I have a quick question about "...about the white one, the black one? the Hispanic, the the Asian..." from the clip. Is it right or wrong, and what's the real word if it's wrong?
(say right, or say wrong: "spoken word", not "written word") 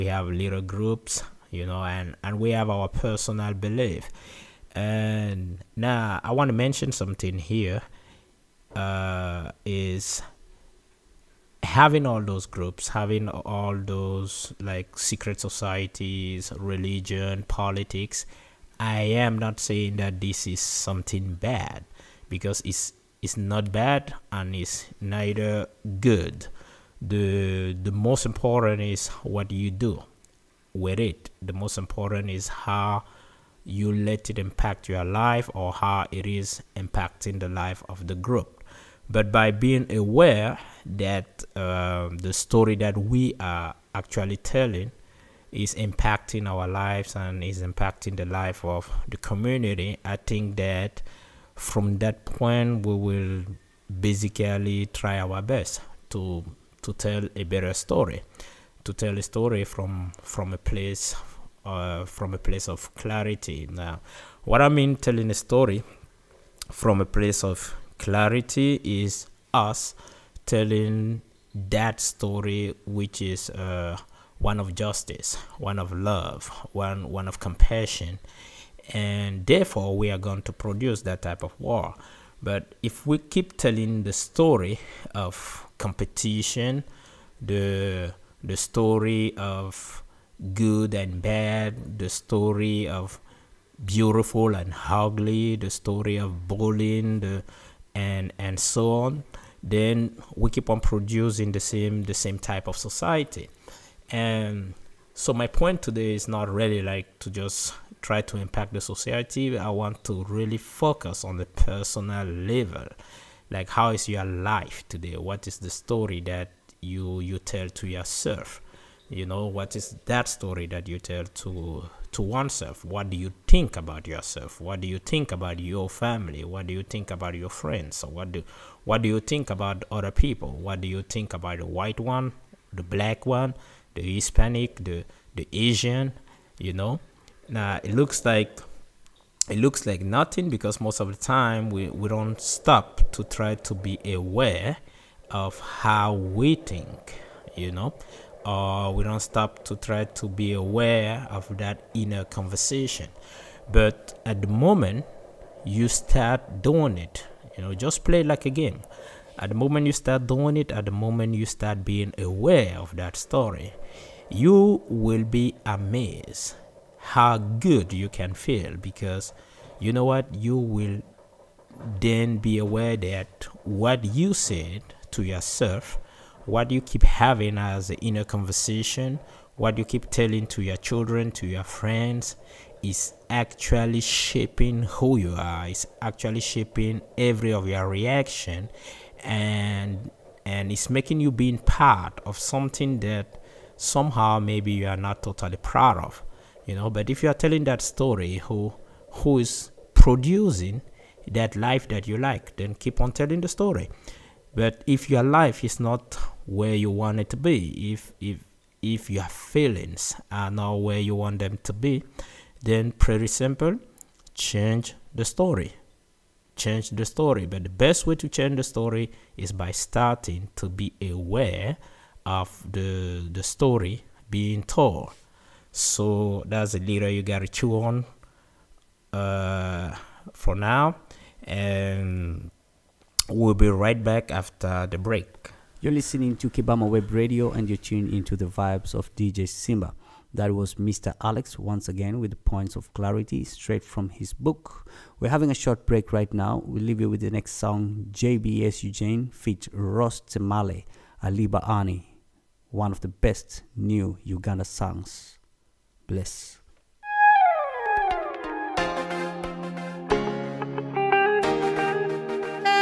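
right.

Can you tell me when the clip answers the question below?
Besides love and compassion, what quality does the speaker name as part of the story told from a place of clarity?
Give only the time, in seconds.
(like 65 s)
74 s.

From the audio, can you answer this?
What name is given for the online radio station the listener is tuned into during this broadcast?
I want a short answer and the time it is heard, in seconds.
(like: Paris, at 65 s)
Kibama Web Radio, at 236 s.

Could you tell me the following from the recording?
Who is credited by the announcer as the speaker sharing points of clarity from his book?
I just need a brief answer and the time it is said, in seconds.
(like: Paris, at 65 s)
Mr. Alex, at 240 s.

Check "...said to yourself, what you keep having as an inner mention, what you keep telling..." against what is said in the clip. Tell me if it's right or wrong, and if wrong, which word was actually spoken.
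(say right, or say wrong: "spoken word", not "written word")
wrong: "conversation", not "mention".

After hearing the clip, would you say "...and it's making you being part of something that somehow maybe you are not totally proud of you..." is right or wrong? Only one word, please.
right.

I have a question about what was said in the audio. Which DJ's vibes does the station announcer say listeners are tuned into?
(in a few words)
DJ Simba.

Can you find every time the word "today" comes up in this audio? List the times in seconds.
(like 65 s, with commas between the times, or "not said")
105 s, 114 s.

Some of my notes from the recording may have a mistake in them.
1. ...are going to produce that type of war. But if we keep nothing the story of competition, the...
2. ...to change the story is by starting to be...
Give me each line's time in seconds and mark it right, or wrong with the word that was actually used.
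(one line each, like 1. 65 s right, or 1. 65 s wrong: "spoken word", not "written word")
1. 80 s wrong: "telling", not "nothing"
2. 218 s right.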